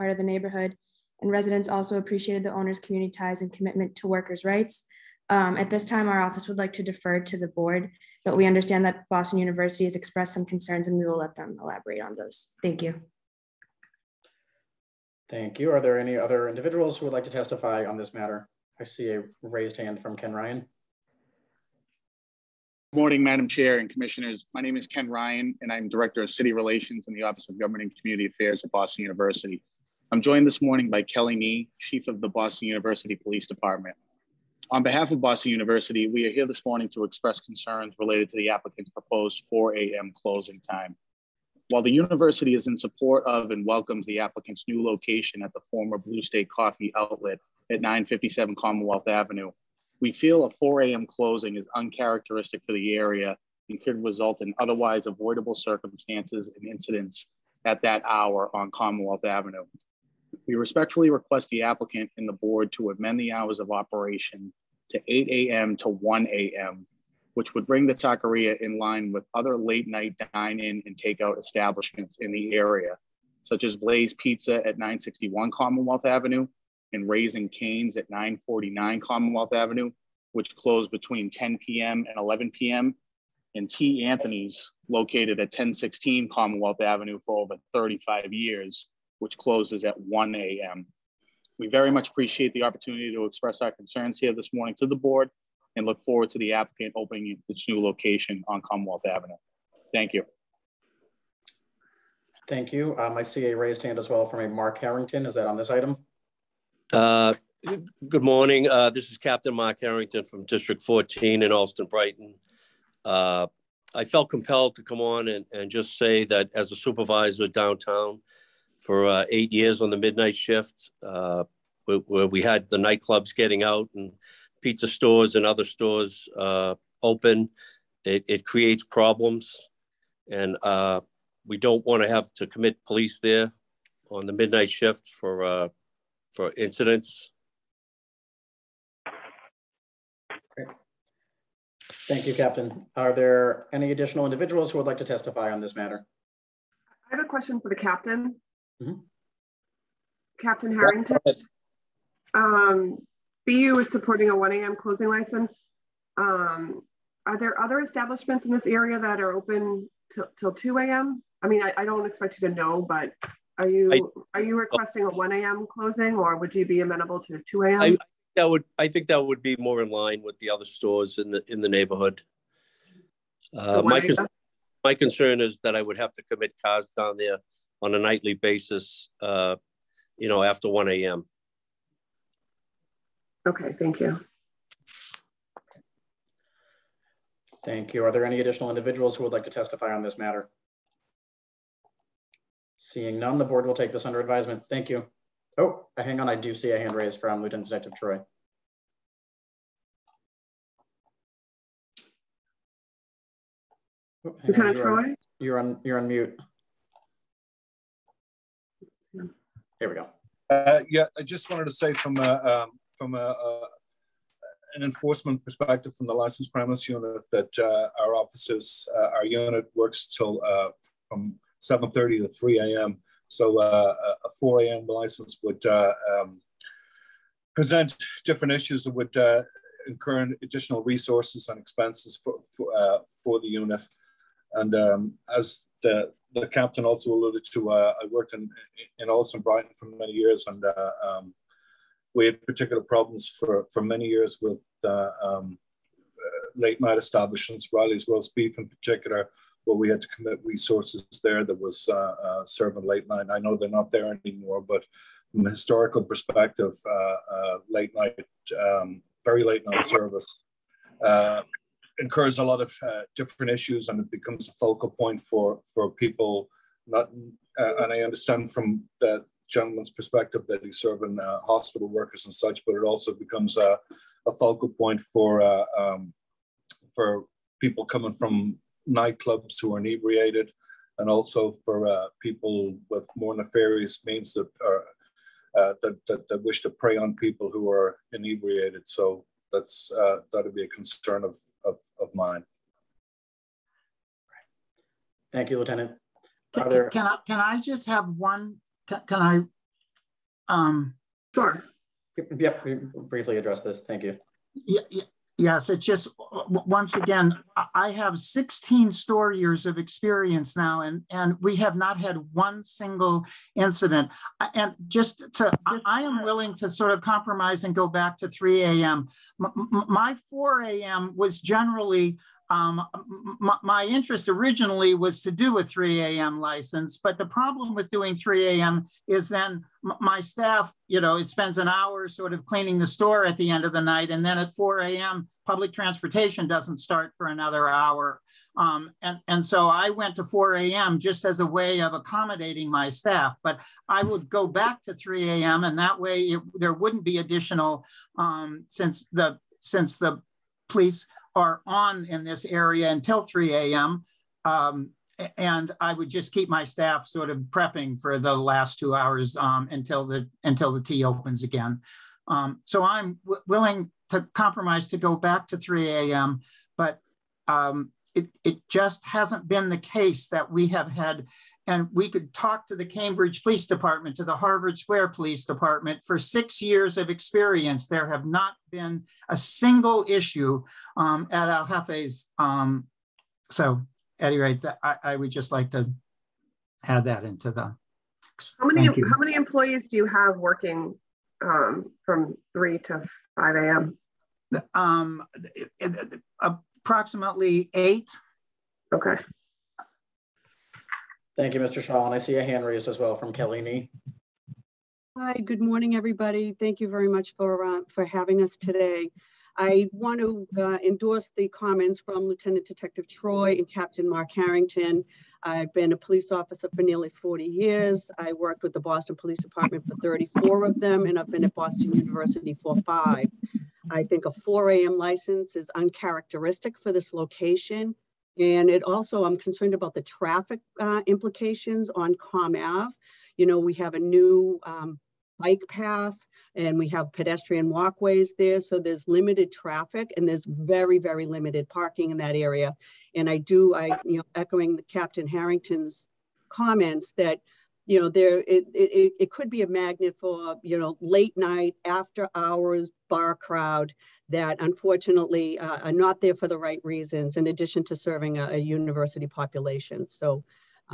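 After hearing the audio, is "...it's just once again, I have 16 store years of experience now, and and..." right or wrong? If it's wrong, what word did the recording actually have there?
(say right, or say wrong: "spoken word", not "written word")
right.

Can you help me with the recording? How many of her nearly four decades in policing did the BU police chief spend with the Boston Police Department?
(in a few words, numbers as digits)
34.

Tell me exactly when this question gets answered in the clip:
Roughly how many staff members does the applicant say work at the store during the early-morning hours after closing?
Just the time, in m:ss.
6:36.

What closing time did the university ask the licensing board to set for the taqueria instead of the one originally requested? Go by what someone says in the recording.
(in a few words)
1 a.m.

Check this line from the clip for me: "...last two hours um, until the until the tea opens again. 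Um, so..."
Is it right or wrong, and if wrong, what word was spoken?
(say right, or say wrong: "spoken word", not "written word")
right.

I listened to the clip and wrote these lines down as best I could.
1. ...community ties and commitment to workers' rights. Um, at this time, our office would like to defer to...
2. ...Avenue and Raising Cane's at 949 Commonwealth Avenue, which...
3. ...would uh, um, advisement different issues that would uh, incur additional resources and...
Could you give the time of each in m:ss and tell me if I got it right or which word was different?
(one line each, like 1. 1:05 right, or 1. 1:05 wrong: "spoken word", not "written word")
1. 0:02 right
2. 1:16 right
3. 3:45 wrong: "present", not "advisement".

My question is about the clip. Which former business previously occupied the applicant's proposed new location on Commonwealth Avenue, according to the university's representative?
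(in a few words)
Blue State Coffee.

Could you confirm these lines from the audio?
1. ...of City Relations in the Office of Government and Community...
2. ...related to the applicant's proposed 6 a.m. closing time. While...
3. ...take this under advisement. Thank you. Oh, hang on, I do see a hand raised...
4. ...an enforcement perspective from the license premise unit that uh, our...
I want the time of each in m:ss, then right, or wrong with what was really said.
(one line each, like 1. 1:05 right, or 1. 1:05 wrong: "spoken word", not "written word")
1. 0:26 right
2. 0:37 wrong: "4", not "6"
3. 3:13 right
4. 3:34 right.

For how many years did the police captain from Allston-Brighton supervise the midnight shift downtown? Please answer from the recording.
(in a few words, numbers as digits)
8.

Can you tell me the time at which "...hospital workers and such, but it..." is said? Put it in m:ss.
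4:31.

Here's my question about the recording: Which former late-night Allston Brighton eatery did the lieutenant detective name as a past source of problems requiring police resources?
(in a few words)
Riley's Roast Beef.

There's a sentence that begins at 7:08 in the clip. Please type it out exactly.
And it also, I'm concerned about the traffic uh, implications on Com Ave.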